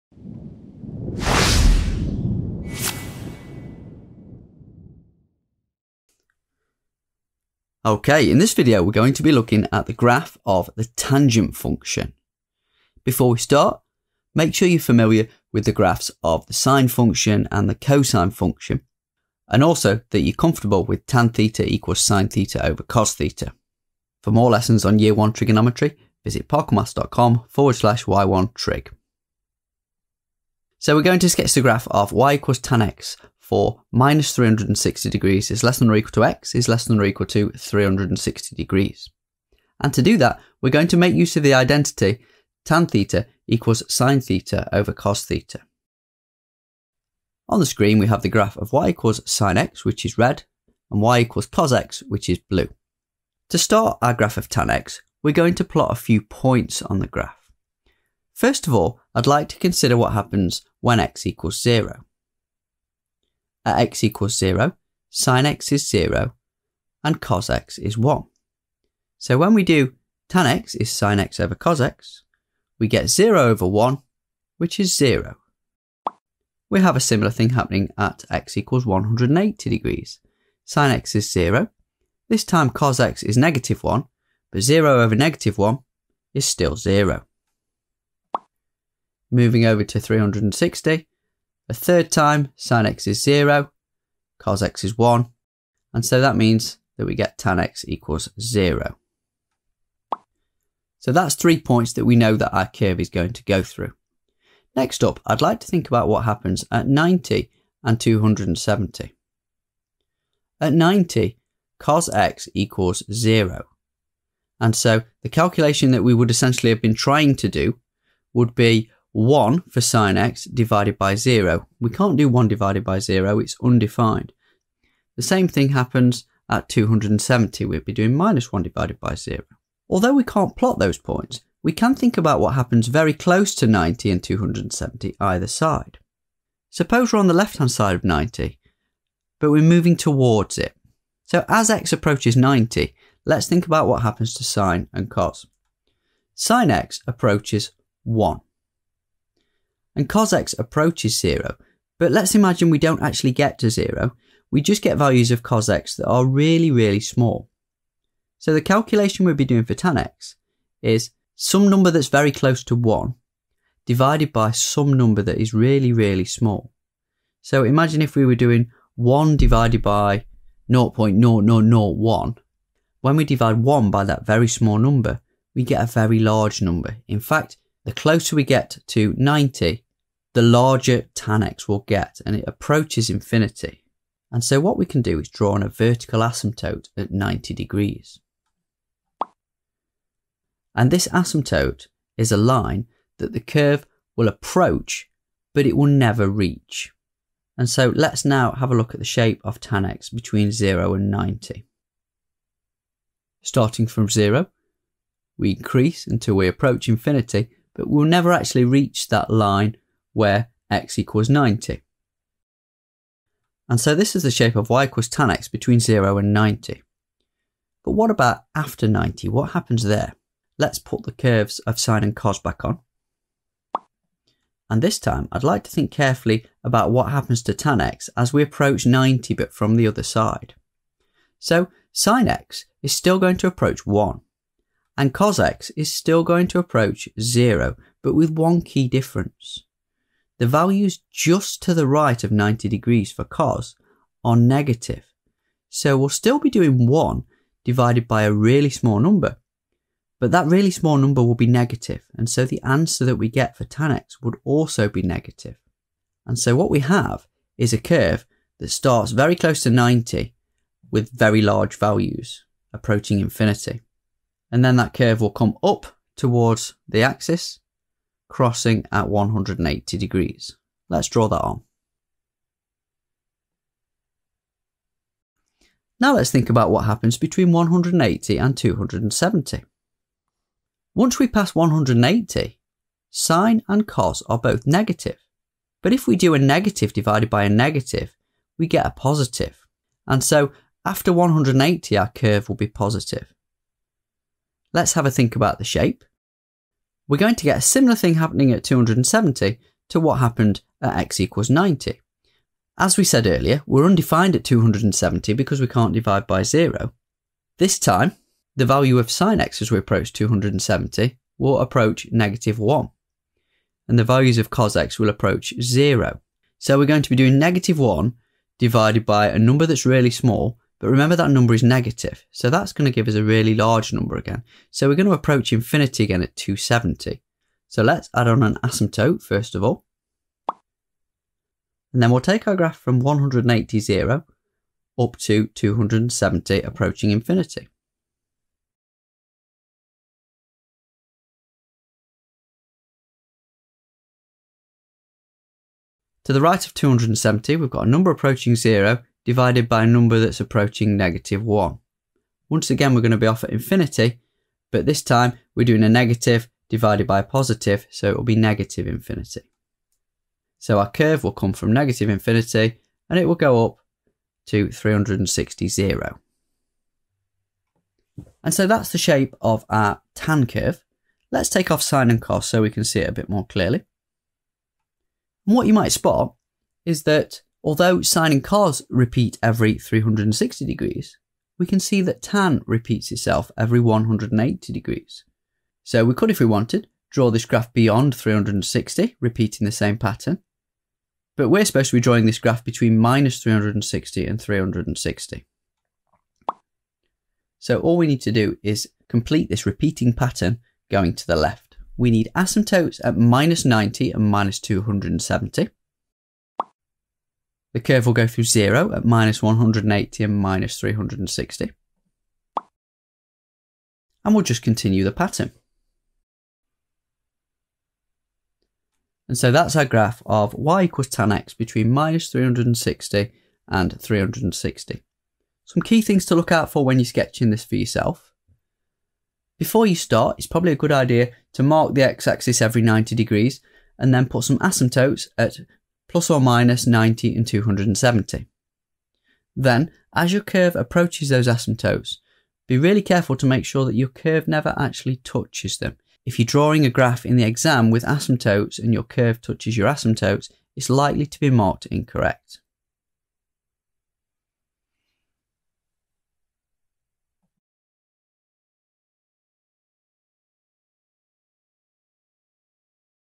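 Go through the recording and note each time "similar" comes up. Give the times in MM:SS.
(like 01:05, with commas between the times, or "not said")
01:17, 04:57.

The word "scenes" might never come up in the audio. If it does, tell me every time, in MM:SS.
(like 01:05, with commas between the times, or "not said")
not said.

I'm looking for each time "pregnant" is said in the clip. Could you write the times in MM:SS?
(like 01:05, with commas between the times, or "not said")
not said.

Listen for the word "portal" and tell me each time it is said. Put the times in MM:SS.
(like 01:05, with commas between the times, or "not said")
not said.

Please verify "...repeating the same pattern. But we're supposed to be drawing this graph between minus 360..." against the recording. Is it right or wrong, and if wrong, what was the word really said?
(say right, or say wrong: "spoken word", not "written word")
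right.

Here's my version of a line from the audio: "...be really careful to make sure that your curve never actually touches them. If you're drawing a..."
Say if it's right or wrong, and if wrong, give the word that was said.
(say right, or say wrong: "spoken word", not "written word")
right.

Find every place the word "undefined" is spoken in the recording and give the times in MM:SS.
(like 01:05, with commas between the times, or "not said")
02:03, 05:03.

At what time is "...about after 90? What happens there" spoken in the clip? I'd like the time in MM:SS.
03:38.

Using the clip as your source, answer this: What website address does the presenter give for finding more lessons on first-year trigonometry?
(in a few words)
parkermaths.com/y1trig.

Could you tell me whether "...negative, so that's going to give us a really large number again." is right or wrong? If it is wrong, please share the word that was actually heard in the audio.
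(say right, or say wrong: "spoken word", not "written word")
right.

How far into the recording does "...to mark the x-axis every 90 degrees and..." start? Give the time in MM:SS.
07:11.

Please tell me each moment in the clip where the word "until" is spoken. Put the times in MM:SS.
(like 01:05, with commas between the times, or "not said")
03:26.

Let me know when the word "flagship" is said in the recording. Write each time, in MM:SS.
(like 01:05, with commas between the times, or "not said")
not said.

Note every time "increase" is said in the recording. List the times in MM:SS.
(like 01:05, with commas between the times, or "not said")
03:25.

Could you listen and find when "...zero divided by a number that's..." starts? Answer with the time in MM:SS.
05:48.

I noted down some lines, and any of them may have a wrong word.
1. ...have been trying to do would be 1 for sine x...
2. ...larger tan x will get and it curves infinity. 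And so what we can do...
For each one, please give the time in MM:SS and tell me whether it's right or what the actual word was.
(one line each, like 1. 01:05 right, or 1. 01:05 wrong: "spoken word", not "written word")
1. 01:56 right
2. 03:00 wrong: "approaches", not "curves".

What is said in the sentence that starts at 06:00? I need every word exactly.
So our curve will come from negative infinity and it will go up to 360 zero.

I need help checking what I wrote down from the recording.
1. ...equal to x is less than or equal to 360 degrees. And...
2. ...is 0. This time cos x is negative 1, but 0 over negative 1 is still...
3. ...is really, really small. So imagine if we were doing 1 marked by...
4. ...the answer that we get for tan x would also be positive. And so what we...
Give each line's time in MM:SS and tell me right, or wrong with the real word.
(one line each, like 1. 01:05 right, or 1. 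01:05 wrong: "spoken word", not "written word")
1. 00:35 right
2. 01:21 right
3. 02:45 wrong: "divided", not "marked"
4. 04:12 wrong: "negative", not "positive".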